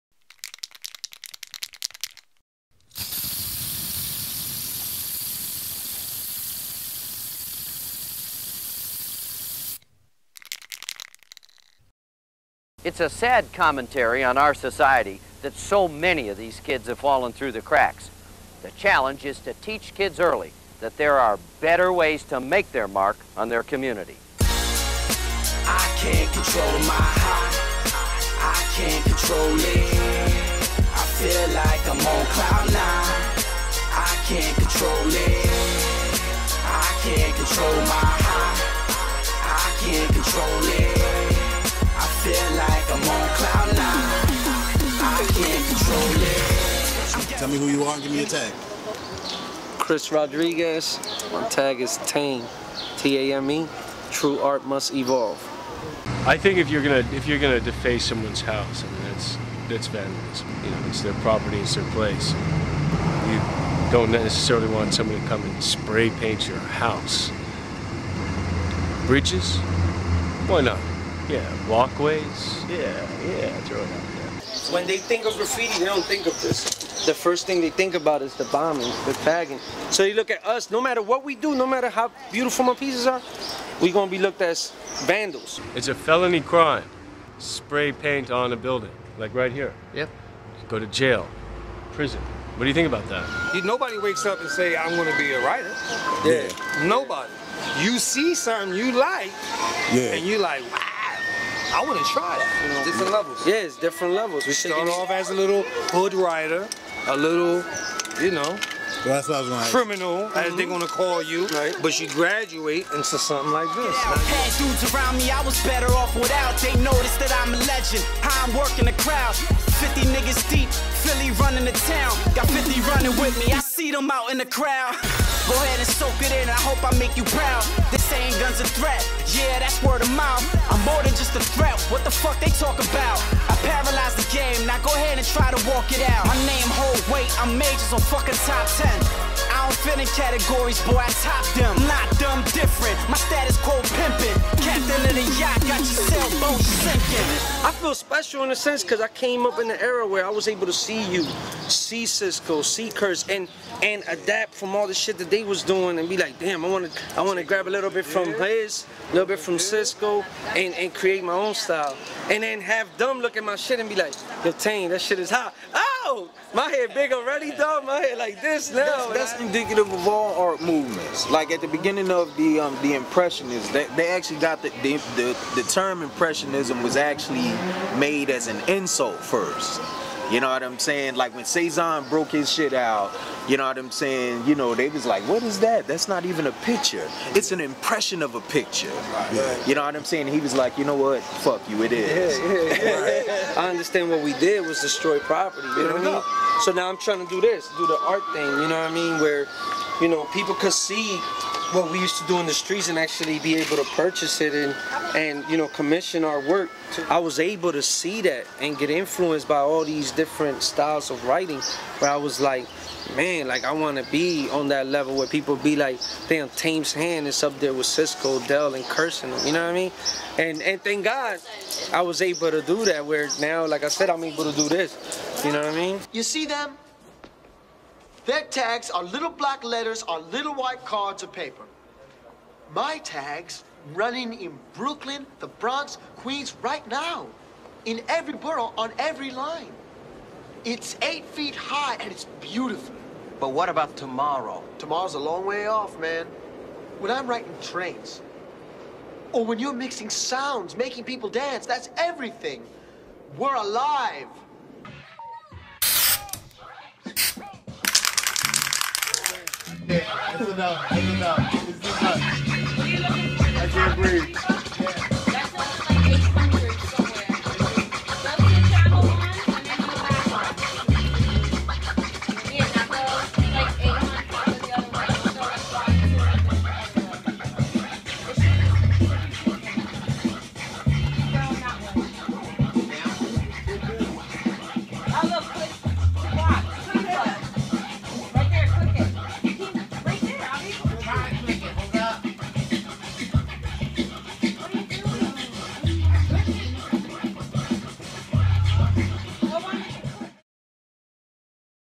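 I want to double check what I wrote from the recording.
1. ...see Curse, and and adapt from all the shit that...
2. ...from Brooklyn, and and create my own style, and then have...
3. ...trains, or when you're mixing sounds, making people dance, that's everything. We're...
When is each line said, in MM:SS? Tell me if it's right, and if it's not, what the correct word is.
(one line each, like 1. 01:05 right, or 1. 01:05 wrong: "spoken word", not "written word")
1. 02:32 right
2. 02:39 wrong: "Cisco", not "Brooklyn"
3. 04:07 right.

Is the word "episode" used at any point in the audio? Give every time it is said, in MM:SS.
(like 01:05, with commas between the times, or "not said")
not said.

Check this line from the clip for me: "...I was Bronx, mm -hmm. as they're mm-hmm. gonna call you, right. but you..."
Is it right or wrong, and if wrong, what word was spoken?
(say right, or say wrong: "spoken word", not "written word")
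wrong: "Criminal", not "Bronx".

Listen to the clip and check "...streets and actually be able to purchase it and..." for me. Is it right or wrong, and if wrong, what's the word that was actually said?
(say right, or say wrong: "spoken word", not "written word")
right.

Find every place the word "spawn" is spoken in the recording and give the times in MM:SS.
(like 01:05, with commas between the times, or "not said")
not said.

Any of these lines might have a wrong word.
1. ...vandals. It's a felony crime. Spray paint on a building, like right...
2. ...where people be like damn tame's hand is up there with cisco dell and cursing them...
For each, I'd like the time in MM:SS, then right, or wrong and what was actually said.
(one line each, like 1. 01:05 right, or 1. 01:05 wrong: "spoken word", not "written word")
1. 01:25 right
2. 03:35 right.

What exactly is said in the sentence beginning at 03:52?
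My tags running in Brooklyn, the Bronx, Queens right now.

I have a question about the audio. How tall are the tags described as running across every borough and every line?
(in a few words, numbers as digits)
8 feet.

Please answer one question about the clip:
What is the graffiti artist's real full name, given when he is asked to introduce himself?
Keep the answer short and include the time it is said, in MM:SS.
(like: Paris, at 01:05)
Chris Rodriguez, at 00:49.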